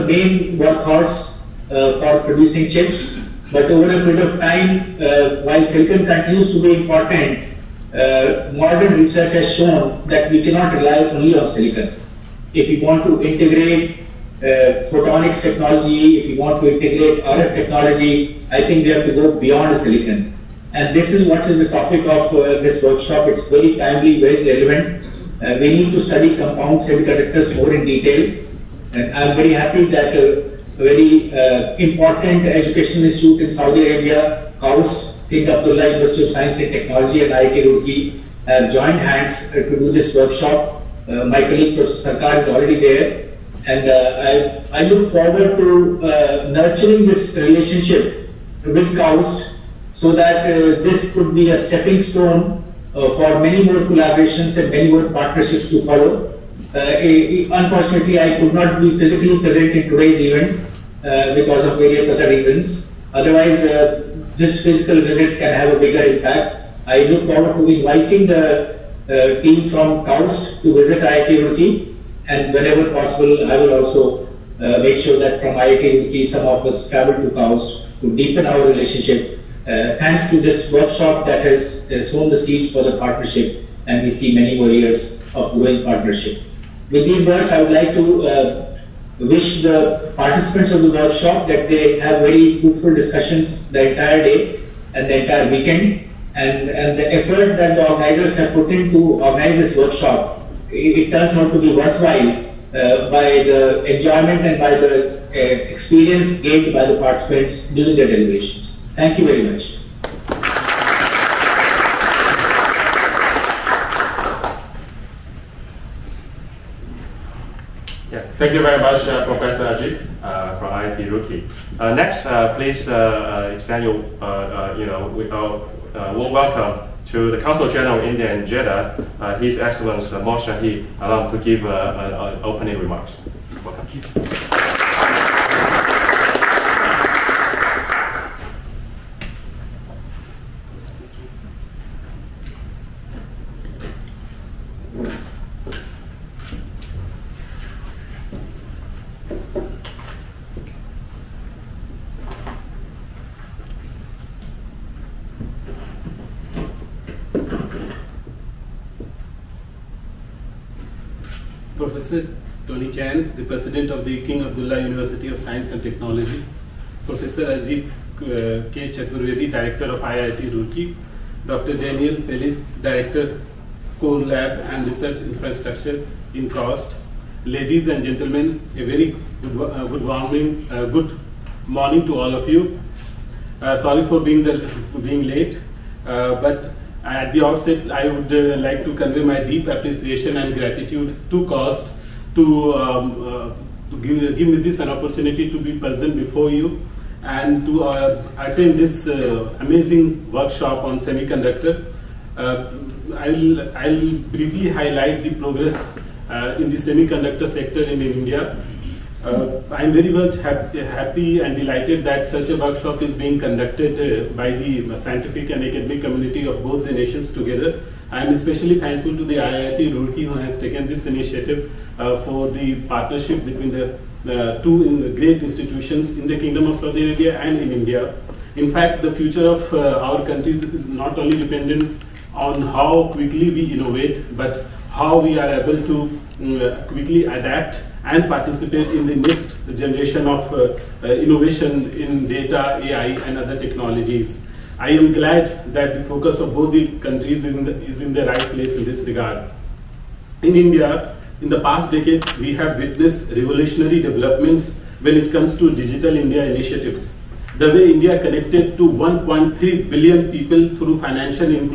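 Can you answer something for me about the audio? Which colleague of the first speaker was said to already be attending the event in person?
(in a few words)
Professor Sarkar.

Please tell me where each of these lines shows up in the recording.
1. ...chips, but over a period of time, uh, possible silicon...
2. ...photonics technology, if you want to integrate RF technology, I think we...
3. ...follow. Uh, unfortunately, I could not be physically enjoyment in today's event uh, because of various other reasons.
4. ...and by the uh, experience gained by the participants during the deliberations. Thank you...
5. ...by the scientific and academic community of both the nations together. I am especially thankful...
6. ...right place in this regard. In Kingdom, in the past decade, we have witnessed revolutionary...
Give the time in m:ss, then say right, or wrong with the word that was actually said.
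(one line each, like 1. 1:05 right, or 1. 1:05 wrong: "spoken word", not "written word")
1. 0:02 wrong: "while", not "possible"
2. 0:14 right
3. 0:55 wrong: "present", not "enjoyment"
4. 1:44 right
5. 3:34 right
6. 4:08 wrong: "India", not "Kingdom".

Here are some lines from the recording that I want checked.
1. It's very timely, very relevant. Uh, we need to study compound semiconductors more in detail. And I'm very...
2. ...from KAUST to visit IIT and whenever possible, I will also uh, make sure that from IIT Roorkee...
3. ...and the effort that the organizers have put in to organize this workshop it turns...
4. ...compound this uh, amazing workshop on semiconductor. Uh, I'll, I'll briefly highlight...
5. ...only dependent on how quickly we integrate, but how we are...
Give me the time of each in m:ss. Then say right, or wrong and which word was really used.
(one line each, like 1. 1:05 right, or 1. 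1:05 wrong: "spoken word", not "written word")
1. 0:23 right
2. 1:09 right
3. 1:36 right
4. 3:18 wrong: "attend", not "compound"
5. 3:51 wrong: "innovate", not "integrate".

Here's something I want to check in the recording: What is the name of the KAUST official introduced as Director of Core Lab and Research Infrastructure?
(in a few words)
Dr. Daniel Feliz.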